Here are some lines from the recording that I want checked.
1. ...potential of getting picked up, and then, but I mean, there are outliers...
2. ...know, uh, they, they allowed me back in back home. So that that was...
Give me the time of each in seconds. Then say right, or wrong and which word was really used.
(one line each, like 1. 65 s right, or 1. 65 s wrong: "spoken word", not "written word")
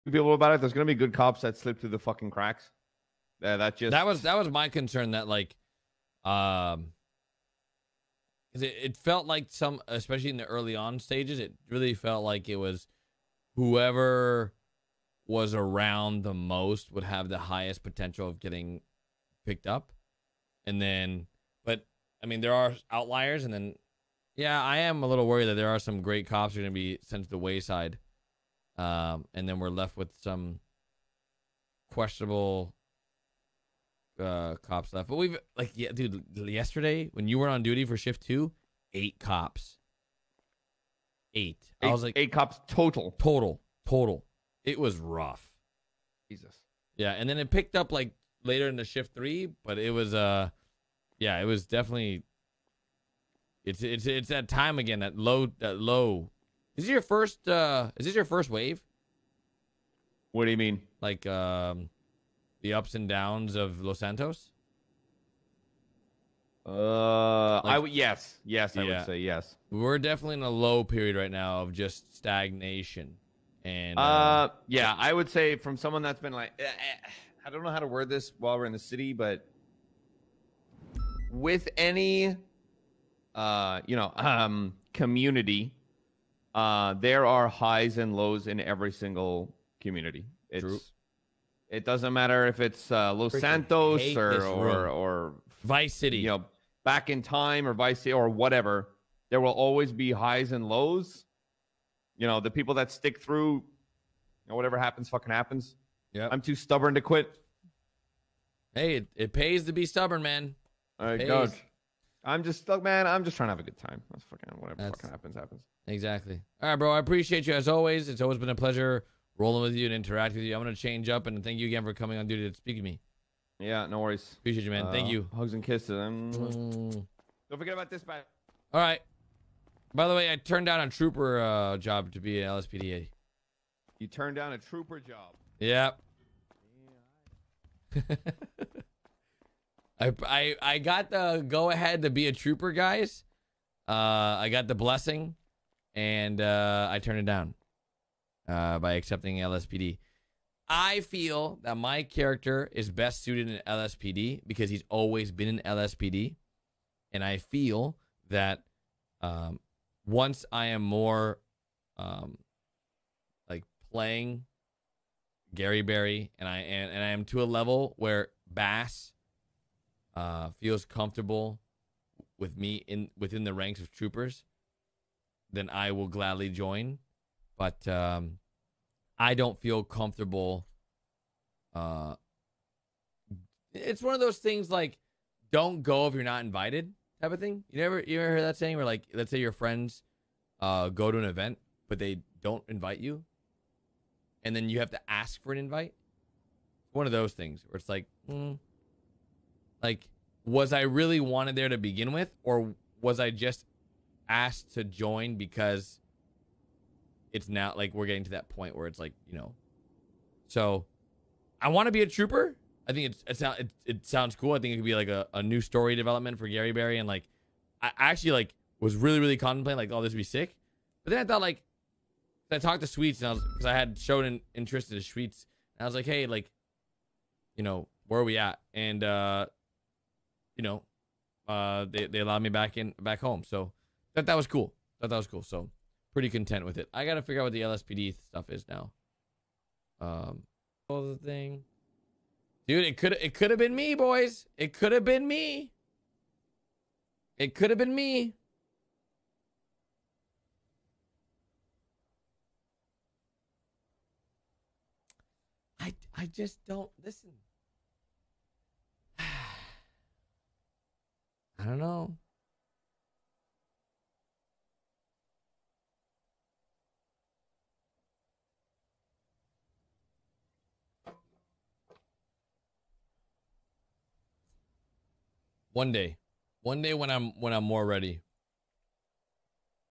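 1. 17 s right
2. 230 s right.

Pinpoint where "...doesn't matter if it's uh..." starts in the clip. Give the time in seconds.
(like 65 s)
91 s.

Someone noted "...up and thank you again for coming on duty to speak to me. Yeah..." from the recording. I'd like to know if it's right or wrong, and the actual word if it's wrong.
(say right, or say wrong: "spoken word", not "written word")
right.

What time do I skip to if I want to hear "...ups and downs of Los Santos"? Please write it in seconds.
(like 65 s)
62 s.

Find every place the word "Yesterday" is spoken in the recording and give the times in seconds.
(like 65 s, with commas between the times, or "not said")
36 s.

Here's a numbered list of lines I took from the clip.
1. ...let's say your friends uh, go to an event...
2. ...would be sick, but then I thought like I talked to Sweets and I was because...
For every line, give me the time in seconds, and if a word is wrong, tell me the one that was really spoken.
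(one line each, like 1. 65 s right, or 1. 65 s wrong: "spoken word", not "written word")
1. 189 s right
2. 220 s right.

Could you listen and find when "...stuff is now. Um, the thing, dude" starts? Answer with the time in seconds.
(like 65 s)
238 s.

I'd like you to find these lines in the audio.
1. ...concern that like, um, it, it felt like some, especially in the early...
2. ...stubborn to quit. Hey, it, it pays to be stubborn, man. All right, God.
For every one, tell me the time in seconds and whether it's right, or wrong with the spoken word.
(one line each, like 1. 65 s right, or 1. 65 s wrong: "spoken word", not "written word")
1. 4 s right
2. 106 s right.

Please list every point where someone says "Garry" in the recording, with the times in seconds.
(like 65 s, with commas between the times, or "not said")
165 s, 216 s.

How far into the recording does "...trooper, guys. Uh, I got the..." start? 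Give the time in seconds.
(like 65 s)
142 s.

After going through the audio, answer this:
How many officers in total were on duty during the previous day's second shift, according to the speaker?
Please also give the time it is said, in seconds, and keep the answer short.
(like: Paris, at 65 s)
8, at 42 s.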